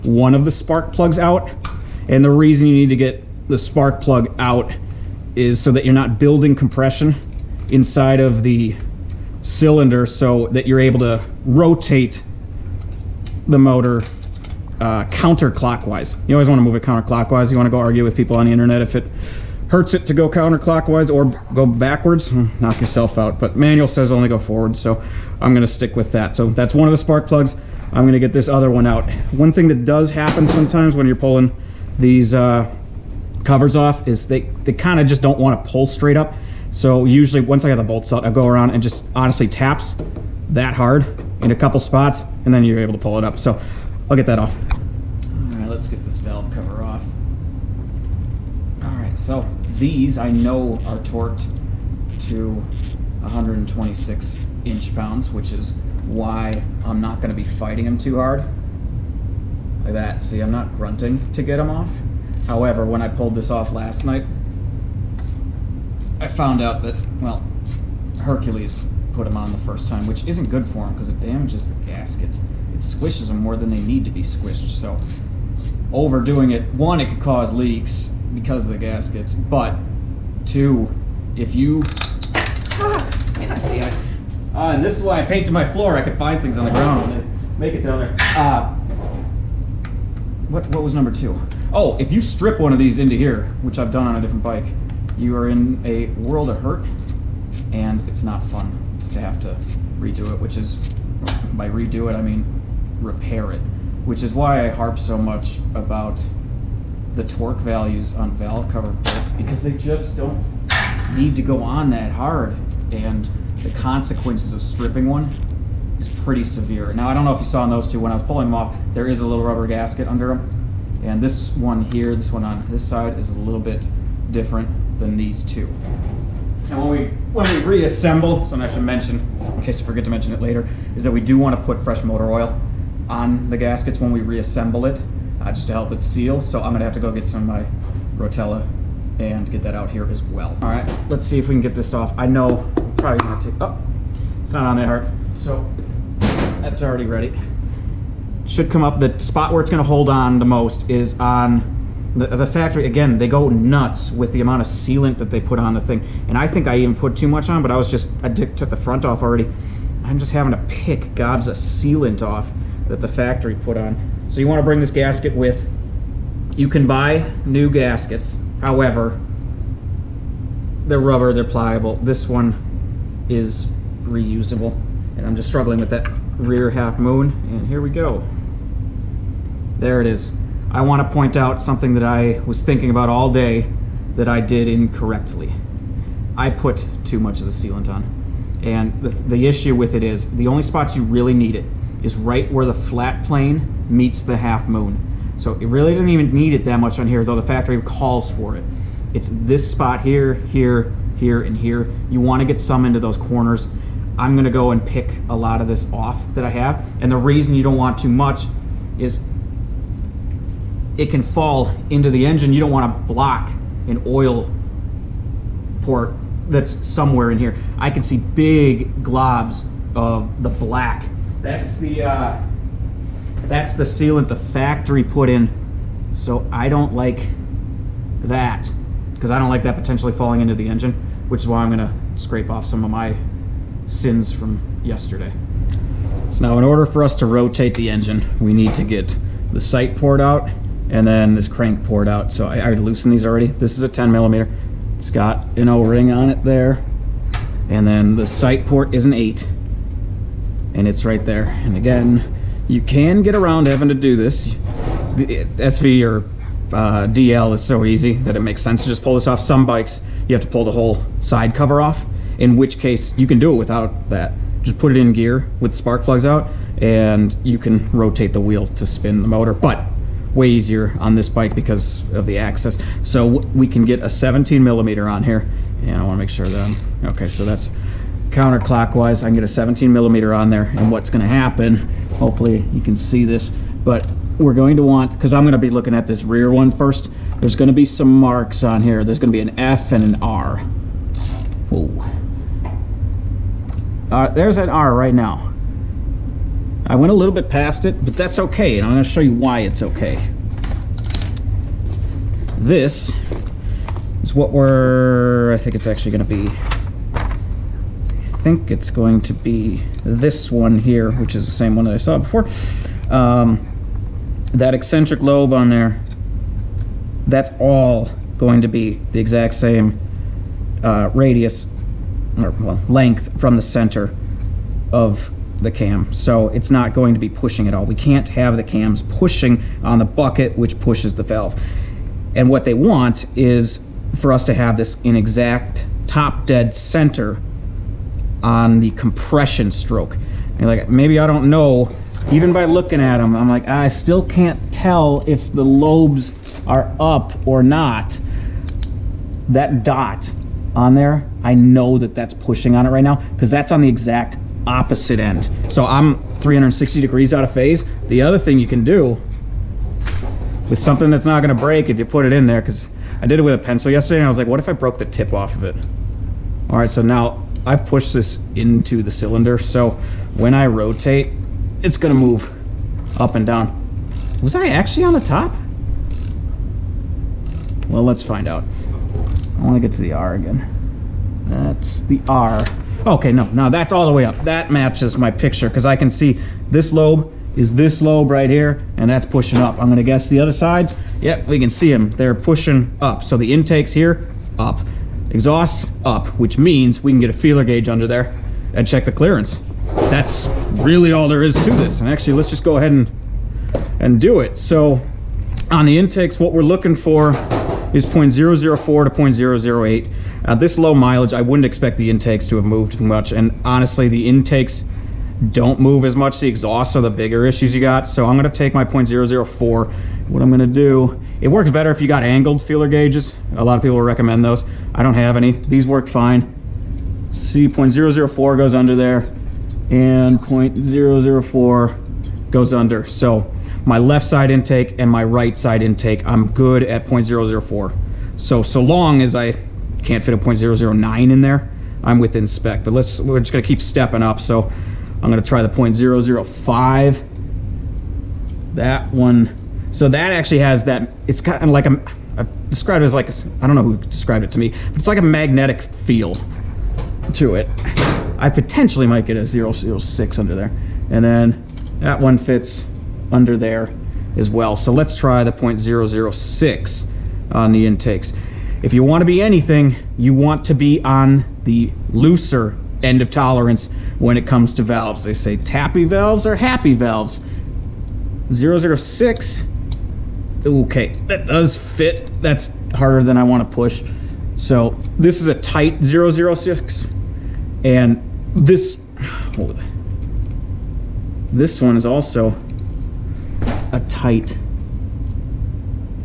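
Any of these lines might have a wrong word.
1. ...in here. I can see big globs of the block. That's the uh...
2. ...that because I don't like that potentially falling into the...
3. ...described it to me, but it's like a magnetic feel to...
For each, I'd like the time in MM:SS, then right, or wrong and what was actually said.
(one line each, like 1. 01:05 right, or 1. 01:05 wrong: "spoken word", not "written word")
1. 03:37 wrong: "black", not "block"
2. 03:48 right
3. 07:33 right.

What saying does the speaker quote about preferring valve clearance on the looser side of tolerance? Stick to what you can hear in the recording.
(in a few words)
Tappy valves are happy valves.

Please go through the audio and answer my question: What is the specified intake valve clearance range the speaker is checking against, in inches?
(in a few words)
0.004 to 0.008.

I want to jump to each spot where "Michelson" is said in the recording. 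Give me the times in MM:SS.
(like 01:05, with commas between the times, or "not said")
not said.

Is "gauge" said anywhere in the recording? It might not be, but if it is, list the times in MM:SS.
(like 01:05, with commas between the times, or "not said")
06:37, 07:02.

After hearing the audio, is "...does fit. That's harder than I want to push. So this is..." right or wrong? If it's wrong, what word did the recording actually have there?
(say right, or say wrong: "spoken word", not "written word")
right.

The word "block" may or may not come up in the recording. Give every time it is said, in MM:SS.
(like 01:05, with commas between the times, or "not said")
03:33.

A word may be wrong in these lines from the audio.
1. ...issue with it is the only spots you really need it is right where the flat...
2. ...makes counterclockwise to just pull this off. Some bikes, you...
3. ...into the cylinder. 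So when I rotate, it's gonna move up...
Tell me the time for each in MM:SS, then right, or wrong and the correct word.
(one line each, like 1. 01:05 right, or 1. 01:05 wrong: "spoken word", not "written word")
1. 03:09 right
2. 04:18 wrong: "sense", not "counterclockwise"
3. 06:08 right.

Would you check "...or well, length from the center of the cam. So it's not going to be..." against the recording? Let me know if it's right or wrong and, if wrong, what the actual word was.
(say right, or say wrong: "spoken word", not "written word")
right.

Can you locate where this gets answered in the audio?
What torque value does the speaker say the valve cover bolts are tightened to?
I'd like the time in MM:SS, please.
00:53.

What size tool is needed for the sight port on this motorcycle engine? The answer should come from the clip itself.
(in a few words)
8.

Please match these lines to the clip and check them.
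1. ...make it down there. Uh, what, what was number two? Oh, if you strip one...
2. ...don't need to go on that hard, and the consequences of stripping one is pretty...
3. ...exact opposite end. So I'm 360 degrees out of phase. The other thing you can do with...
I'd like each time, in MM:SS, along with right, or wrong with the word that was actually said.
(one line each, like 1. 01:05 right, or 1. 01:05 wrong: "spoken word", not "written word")
1. 01:27 right
2. 01:50 right
3. 05:53 right.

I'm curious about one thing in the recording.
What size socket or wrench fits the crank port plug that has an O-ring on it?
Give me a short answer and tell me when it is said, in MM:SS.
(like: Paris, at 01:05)
10 millimeter, at 04:03.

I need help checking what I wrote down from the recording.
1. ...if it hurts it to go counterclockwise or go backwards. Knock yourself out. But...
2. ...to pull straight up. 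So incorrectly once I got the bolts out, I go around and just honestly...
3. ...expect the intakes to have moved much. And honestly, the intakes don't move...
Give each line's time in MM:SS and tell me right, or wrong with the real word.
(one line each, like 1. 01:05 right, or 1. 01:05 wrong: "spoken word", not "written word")
1. 00:18 right
2. 00:35 wrong: "usually", not "incorrectly"
3. 06:51 right.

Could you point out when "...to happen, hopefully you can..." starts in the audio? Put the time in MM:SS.
04:41.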